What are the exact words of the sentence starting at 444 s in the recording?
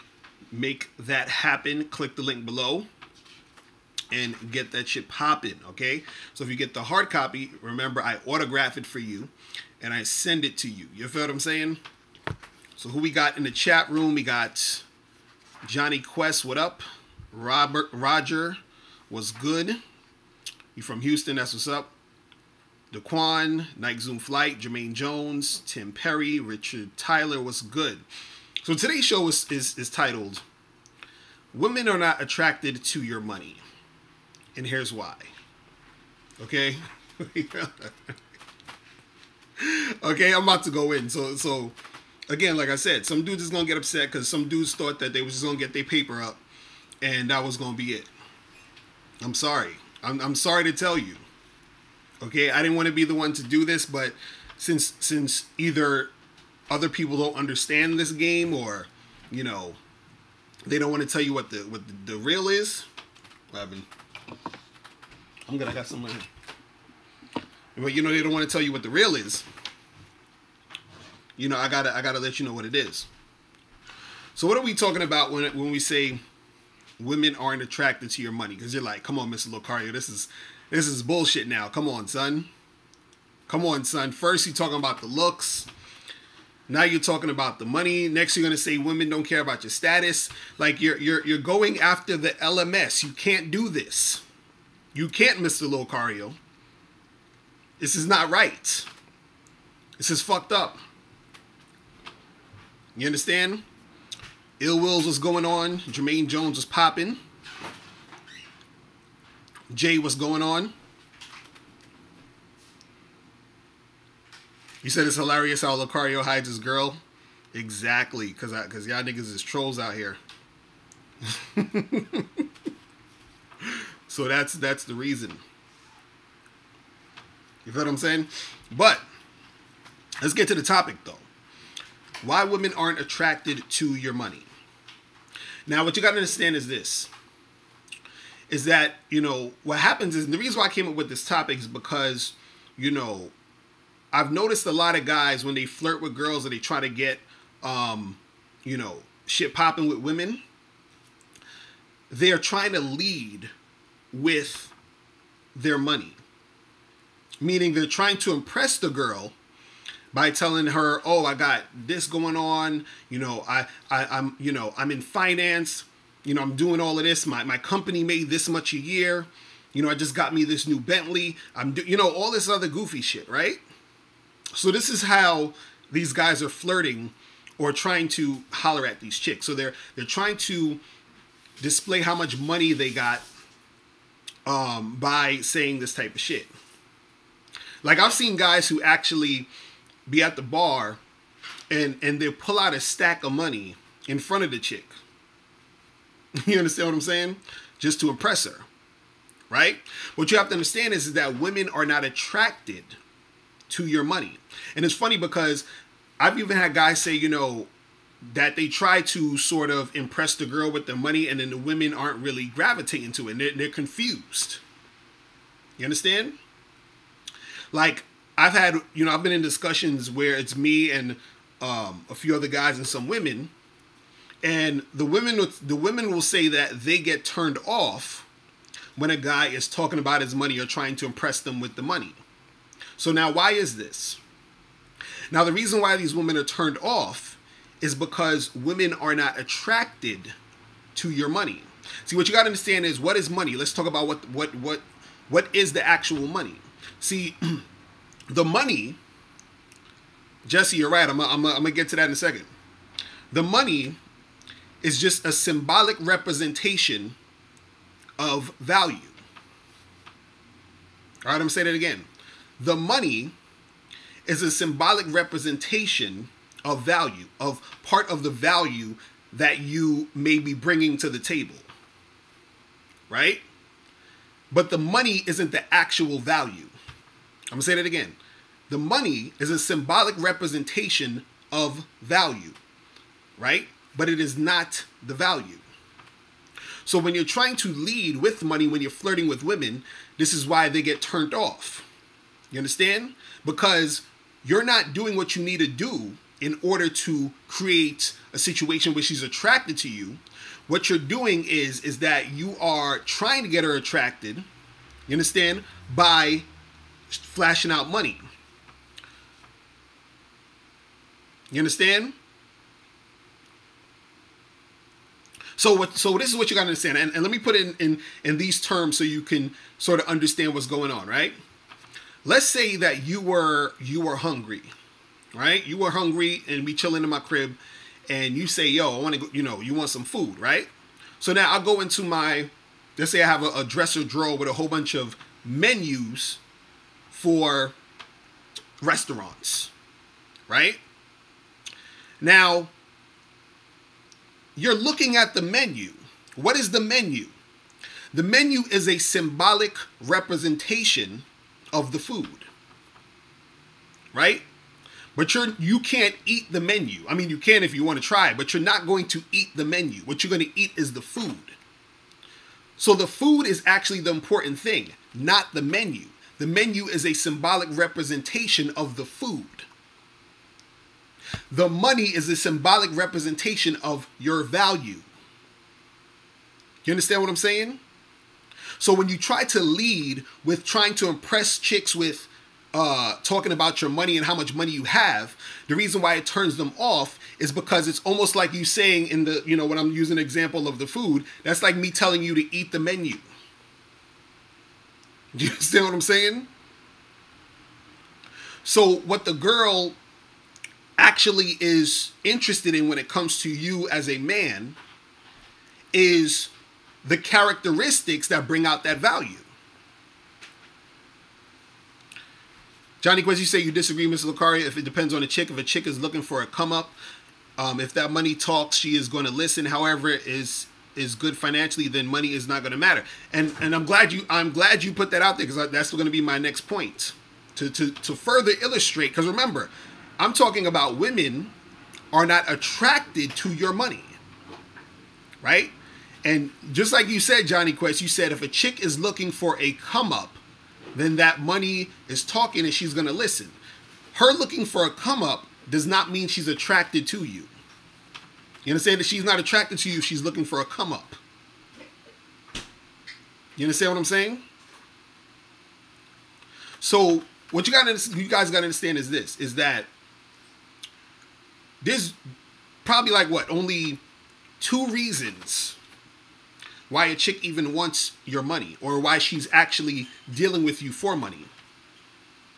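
Her looking for a come up does not mean she's attracted to you.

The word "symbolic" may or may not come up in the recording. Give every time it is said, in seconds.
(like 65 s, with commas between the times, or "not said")
255 s, 264 s, 279 s, 348 s, 367 s, 372 s.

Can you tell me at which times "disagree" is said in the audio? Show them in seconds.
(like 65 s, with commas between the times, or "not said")
413 s.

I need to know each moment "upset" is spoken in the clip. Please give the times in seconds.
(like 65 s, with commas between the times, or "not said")
43 s.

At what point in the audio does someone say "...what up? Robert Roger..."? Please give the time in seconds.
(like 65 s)
16 s.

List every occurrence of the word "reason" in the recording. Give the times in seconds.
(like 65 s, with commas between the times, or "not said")
124 s, 140 s, 235 s, 385 s, 464 s.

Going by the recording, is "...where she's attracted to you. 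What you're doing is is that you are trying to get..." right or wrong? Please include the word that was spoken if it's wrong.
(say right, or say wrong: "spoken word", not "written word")
right.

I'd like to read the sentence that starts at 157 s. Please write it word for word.
Meaning they're trying to impress the girl by telling her, "Oh, I got this going on.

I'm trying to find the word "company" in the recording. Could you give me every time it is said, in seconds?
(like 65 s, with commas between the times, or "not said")
167 s.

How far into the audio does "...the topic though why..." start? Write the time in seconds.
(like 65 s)
130 s.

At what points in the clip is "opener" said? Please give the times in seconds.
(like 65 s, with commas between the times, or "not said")
not said.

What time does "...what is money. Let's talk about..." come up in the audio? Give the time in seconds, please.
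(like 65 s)
243 s.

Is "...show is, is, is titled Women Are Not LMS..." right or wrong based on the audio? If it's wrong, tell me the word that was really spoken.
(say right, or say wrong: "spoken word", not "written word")
wrong: "Attracted", not "LMS".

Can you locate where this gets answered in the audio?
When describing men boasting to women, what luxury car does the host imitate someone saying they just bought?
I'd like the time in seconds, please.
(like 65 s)
170 s.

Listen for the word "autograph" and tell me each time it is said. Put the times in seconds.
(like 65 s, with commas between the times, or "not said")
8 s.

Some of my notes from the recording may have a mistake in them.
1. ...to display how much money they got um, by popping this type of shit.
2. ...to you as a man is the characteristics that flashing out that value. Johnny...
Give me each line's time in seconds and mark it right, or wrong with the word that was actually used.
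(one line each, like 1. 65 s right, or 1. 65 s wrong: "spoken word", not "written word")
1. 180 s wrong: "saying", not "popping"
2. 403 s wrong: "bring", not "flashing".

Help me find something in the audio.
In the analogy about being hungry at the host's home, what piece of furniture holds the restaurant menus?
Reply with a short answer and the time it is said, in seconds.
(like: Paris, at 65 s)
Dresser drawer, at 333 s.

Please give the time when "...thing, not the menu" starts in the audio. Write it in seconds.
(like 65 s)
364 s.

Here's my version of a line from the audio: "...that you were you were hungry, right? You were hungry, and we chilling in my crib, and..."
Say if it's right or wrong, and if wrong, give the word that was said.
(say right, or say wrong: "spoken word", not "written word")
right.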